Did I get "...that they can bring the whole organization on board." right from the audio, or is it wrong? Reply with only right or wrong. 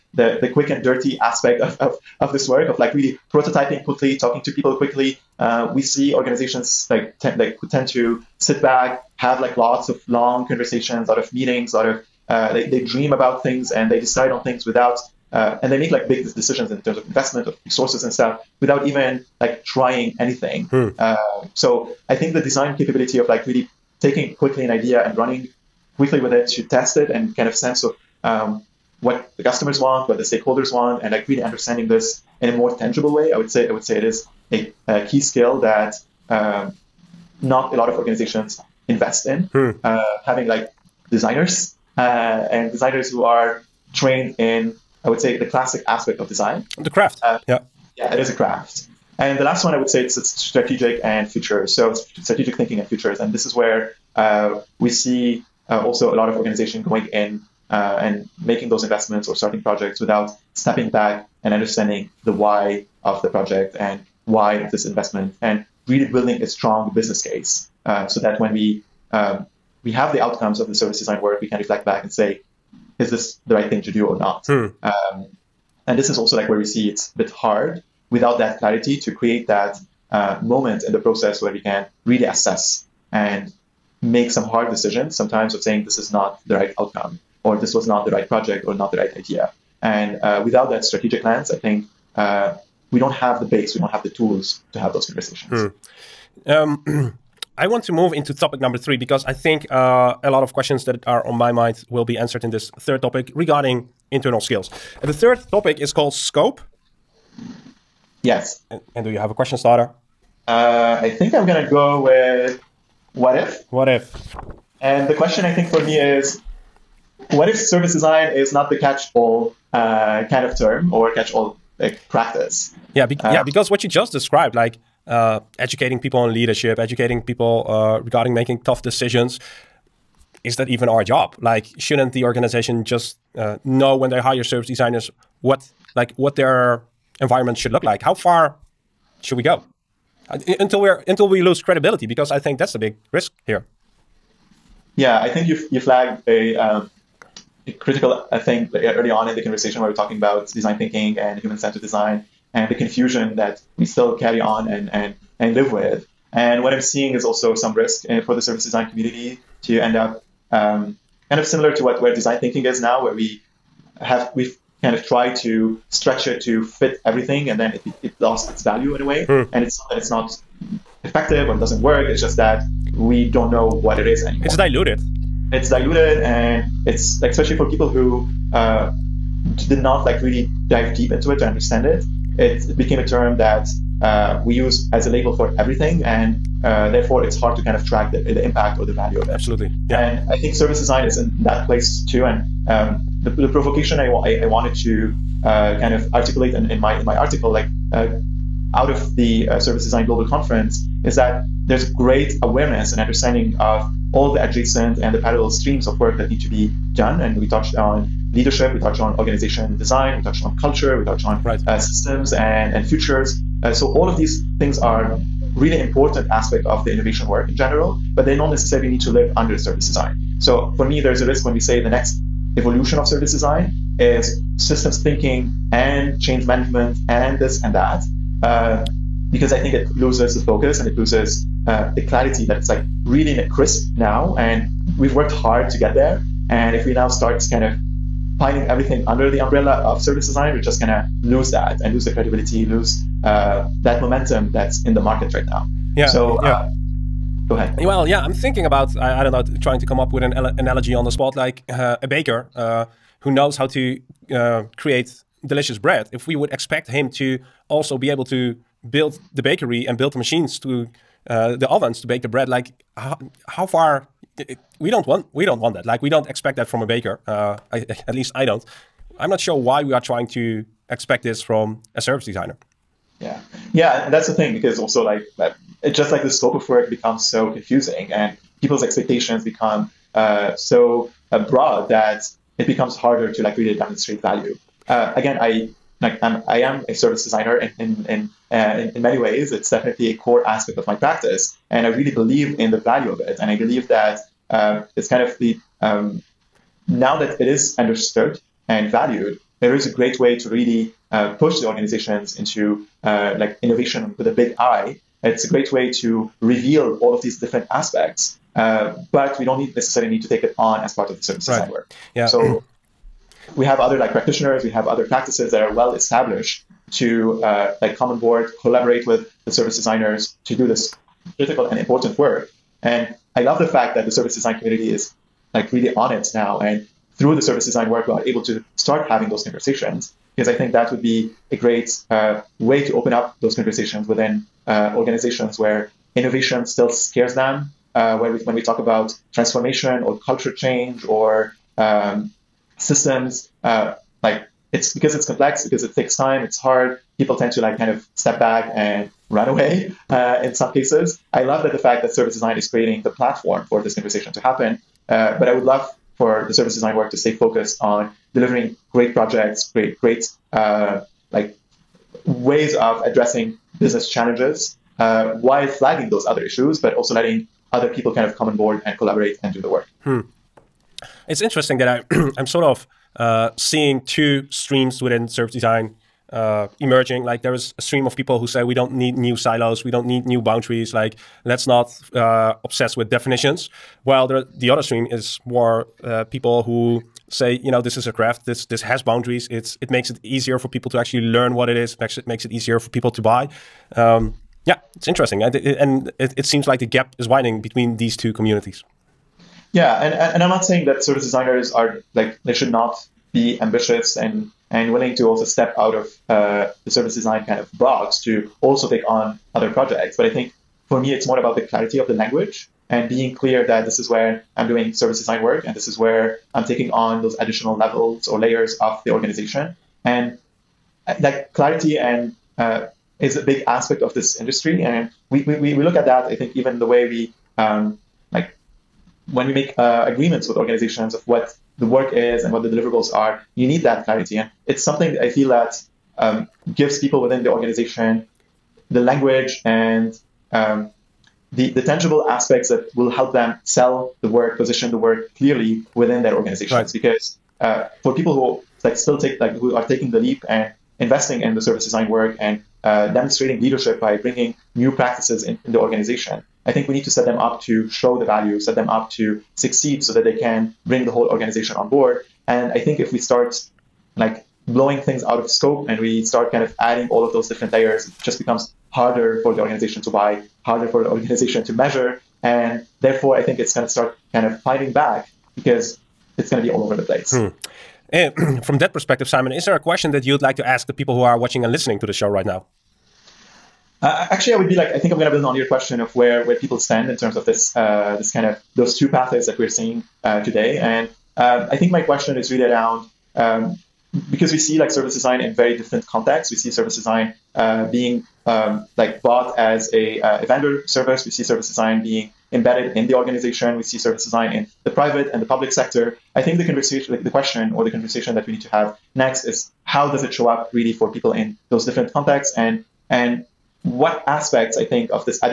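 right.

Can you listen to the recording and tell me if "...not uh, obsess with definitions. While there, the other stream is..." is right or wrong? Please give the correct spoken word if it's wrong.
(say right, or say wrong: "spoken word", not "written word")
right.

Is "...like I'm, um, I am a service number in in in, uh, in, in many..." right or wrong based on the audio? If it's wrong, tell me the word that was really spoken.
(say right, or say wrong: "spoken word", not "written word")
wrong: "designer", not "number".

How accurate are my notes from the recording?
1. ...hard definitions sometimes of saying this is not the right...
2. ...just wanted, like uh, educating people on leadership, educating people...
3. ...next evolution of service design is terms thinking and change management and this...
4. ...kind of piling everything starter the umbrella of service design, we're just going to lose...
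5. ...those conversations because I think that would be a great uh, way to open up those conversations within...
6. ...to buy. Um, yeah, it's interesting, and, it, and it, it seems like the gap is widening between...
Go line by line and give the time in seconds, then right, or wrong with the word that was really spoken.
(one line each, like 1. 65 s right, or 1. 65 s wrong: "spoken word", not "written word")
1. 84 s wrong: "decisions", not "definitions"
2. 123 s wrong: "described", not "wanted"
3. 221 s wrong: "systems", not "terms"
4. 237 s wrong: "under", not "starter"
5. 329 s right
6. 393 s right.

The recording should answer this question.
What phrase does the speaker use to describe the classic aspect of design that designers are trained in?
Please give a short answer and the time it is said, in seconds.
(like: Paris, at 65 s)
The craft, at 46 s.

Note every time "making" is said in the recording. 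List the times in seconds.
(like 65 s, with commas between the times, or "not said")
58 s, 128 s.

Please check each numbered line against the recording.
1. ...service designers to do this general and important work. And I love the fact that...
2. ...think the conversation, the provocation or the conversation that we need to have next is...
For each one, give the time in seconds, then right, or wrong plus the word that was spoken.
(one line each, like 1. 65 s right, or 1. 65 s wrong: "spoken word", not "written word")
1. 319 s wrong: "critical", not "general"
2. 506 s wrong: "question", not "provocation".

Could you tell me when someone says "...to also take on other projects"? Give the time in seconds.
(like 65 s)
408 s.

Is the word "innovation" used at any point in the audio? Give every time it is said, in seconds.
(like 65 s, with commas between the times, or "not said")
216 s, 303 s, 336 s.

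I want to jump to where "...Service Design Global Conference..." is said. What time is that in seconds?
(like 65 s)
199 s.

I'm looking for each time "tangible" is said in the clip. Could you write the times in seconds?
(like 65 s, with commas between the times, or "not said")
32 s, 441 s.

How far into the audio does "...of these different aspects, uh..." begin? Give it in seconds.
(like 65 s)
307 s.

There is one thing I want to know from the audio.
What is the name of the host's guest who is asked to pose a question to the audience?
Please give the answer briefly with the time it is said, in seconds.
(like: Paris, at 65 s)
Simon, at 479 s.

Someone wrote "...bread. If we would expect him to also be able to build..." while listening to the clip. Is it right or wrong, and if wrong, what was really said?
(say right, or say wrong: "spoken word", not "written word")
right.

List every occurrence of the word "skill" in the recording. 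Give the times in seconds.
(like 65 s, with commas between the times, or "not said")
35 s, 104 s.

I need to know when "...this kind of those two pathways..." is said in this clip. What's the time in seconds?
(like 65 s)
488 s.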